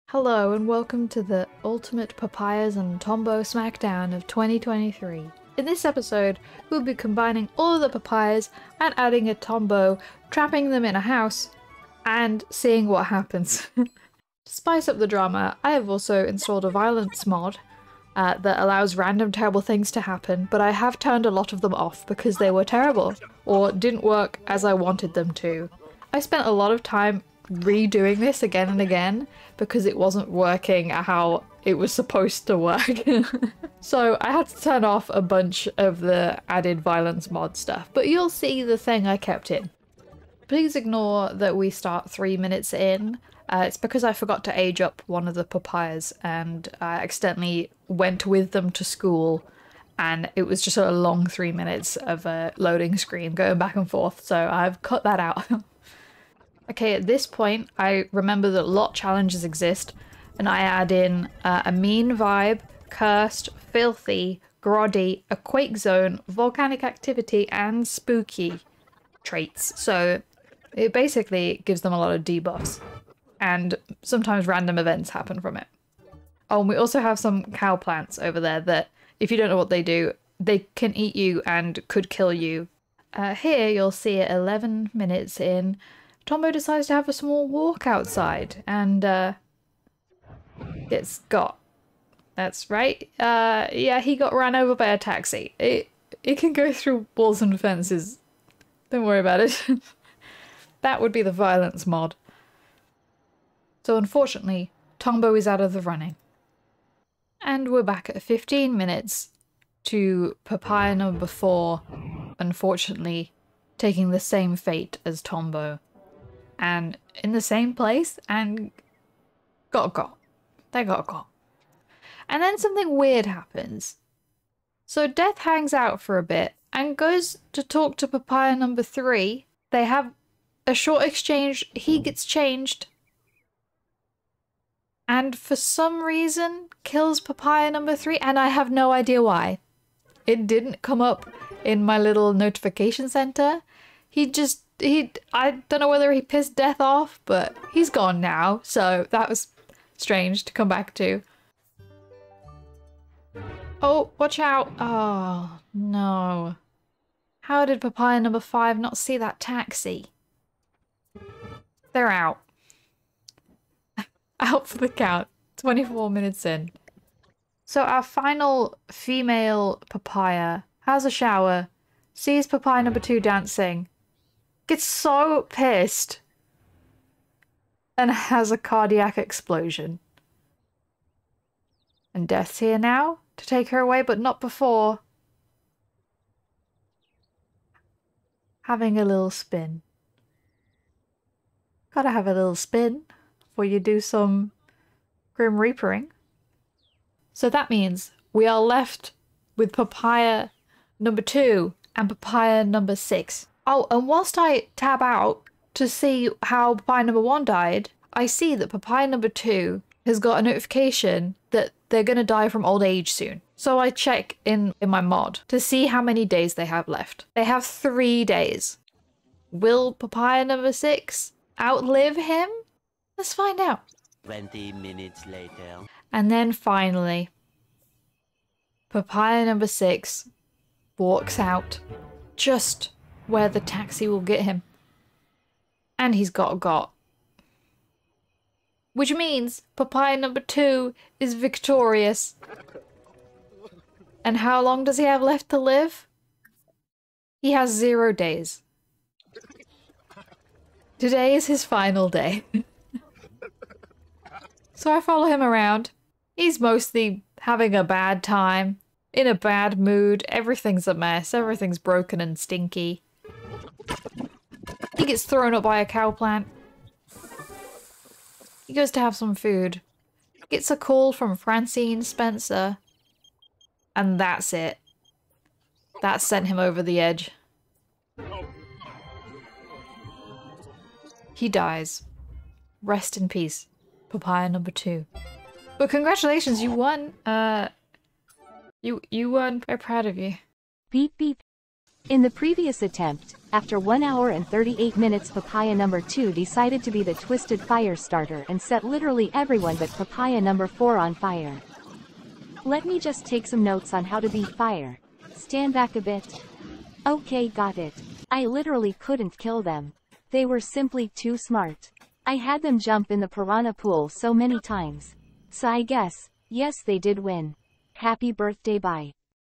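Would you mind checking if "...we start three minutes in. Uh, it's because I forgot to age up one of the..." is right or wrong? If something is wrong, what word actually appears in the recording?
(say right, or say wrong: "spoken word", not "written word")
right.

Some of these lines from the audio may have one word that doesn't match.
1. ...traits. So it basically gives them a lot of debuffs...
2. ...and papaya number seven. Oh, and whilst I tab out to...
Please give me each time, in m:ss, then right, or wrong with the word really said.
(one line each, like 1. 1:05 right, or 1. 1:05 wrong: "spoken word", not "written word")
1. 1:09 right
2. 3:21 wrong: "six", not "seven".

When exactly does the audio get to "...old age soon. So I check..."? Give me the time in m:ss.
3:32.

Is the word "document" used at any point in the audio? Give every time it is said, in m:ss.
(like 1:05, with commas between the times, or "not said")
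not said.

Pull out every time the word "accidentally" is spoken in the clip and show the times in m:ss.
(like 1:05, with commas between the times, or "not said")
0:46.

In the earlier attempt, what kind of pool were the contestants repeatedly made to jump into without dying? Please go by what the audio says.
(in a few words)
Piranha pool.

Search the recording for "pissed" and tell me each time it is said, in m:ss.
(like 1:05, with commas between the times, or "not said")
2:26, 2:55.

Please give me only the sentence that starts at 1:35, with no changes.
It, it can go through walls and fences.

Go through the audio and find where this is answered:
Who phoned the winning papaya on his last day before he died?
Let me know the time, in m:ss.
4:31.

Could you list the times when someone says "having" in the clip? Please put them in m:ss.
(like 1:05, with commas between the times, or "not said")
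3:08, 4:17.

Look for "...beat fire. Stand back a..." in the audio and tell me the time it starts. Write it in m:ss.
5:04.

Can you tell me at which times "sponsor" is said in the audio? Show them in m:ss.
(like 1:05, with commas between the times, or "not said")
not said.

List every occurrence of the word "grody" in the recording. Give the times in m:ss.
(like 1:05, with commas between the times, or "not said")
1:04.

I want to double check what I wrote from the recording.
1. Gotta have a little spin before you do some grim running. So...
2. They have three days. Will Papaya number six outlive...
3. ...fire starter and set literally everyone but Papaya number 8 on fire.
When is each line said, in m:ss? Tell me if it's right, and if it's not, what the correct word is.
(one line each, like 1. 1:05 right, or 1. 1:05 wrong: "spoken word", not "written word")
1. 3:11 wrong: "reapering", not "running"
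2. 3:37 right
3. 4:57 wrong: "4", not "8".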